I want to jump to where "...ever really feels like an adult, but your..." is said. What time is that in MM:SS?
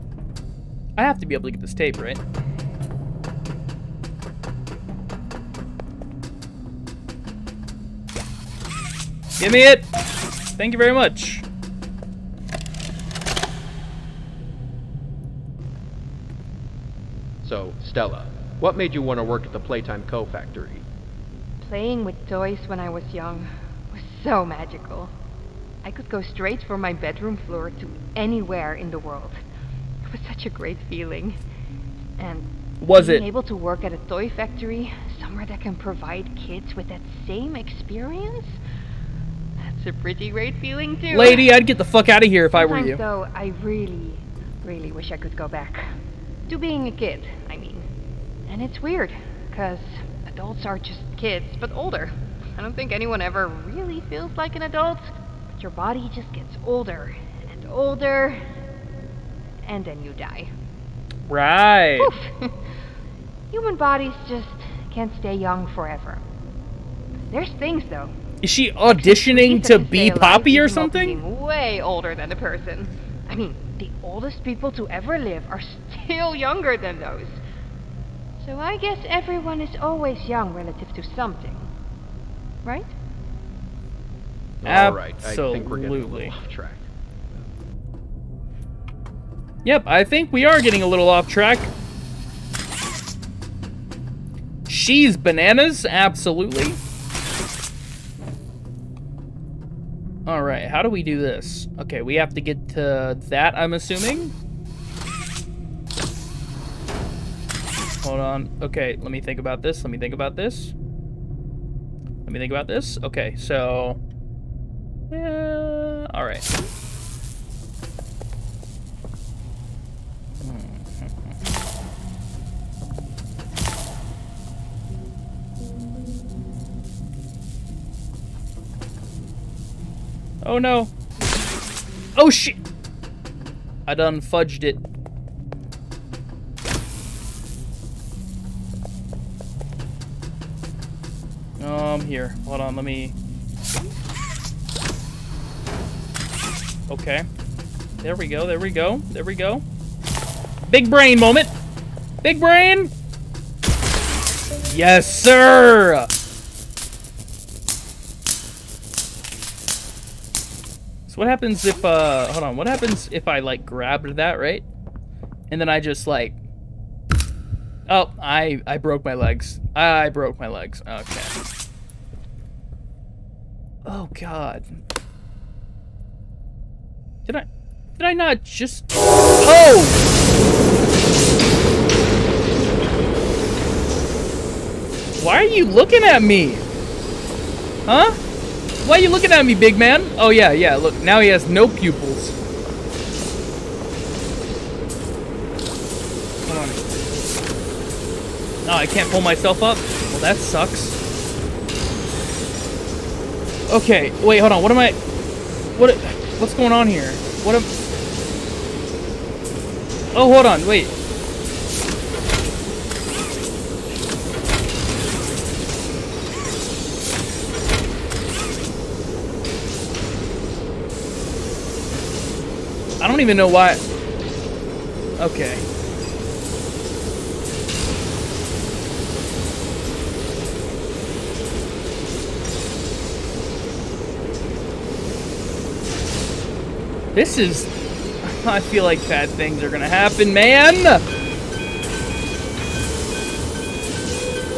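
00:53.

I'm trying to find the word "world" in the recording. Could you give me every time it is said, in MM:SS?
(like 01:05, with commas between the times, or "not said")
00:28.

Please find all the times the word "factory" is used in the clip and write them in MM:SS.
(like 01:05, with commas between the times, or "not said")
00:20, 00:34.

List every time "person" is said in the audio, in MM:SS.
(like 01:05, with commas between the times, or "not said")
01:12.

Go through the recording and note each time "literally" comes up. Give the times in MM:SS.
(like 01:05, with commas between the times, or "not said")
not said.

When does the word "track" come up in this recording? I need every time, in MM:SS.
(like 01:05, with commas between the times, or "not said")
01:26, 01:31.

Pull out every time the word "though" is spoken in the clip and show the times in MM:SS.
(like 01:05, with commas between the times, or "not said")
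00:42, 01:07.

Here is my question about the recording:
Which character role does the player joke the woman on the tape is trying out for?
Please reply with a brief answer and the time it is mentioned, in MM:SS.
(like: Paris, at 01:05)
Poppy, at 01:10.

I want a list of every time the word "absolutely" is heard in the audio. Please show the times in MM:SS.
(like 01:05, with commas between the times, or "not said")
01:35.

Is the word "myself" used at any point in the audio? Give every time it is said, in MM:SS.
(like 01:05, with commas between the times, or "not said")
03:19.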